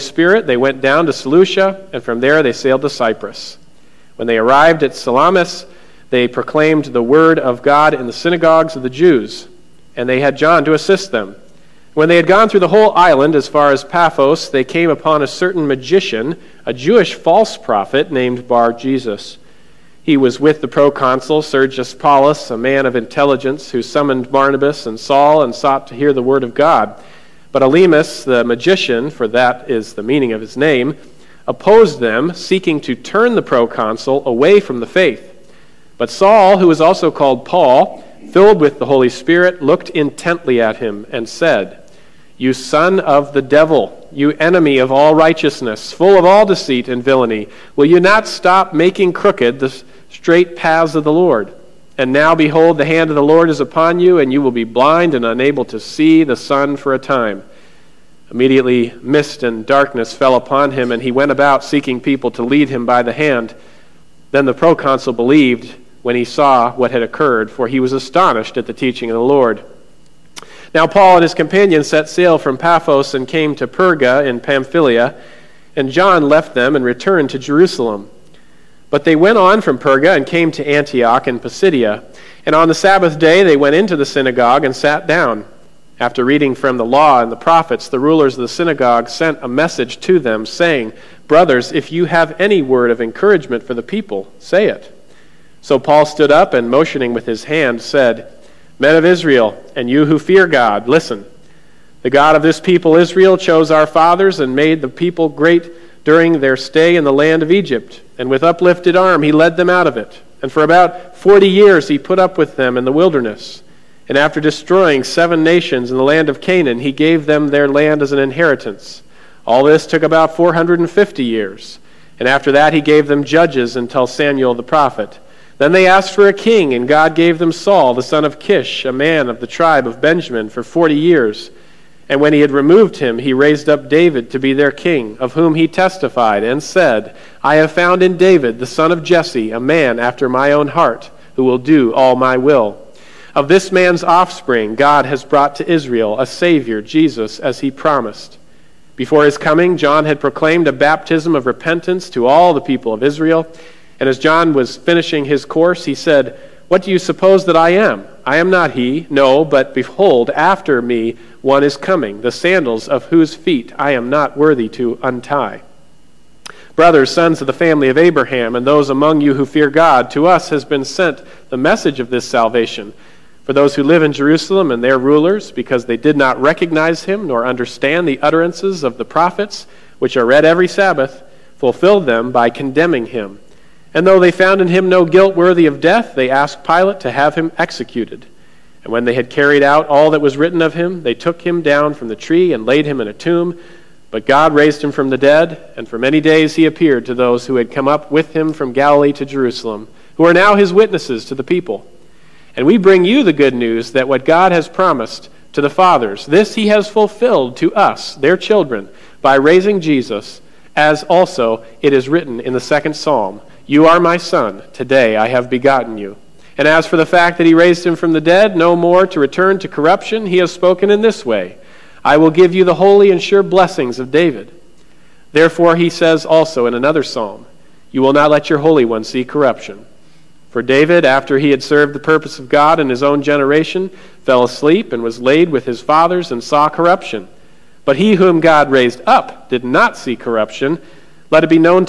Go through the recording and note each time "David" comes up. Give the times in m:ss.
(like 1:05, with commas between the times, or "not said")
2:13, 2:18, 3:44, 3:50.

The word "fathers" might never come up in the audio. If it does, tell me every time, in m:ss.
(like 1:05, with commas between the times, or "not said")
1:43, 3:25, 3:55.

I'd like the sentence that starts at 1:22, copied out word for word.
And on the Sabbath day they went into the synagogue and sat down.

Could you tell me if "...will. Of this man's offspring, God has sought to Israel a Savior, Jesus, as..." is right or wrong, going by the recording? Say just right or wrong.
wrong.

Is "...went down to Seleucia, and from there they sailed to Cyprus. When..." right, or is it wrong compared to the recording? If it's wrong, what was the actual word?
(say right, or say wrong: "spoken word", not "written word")
right.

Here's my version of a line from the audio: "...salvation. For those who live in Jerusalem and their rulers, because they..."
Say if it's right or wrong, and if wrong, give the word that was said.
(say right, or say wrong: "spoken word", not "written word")
right.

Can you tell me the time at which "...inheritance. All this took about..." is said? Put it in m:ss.
1:58.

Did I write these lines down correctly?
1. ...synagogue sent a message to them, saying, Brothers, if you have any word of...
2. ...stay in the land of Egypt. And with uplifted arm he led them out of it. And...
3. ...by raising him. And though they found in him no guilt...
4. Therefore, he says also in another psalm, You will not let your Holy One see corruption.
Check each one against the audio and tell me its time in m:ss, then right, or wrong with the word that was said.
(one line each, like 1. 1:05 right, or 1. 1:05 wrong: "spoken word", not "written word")
1. 1:28 right
2. 1:46 right
3. 3:02 wrong: "condemning", not "raising"
4. 3:45 right.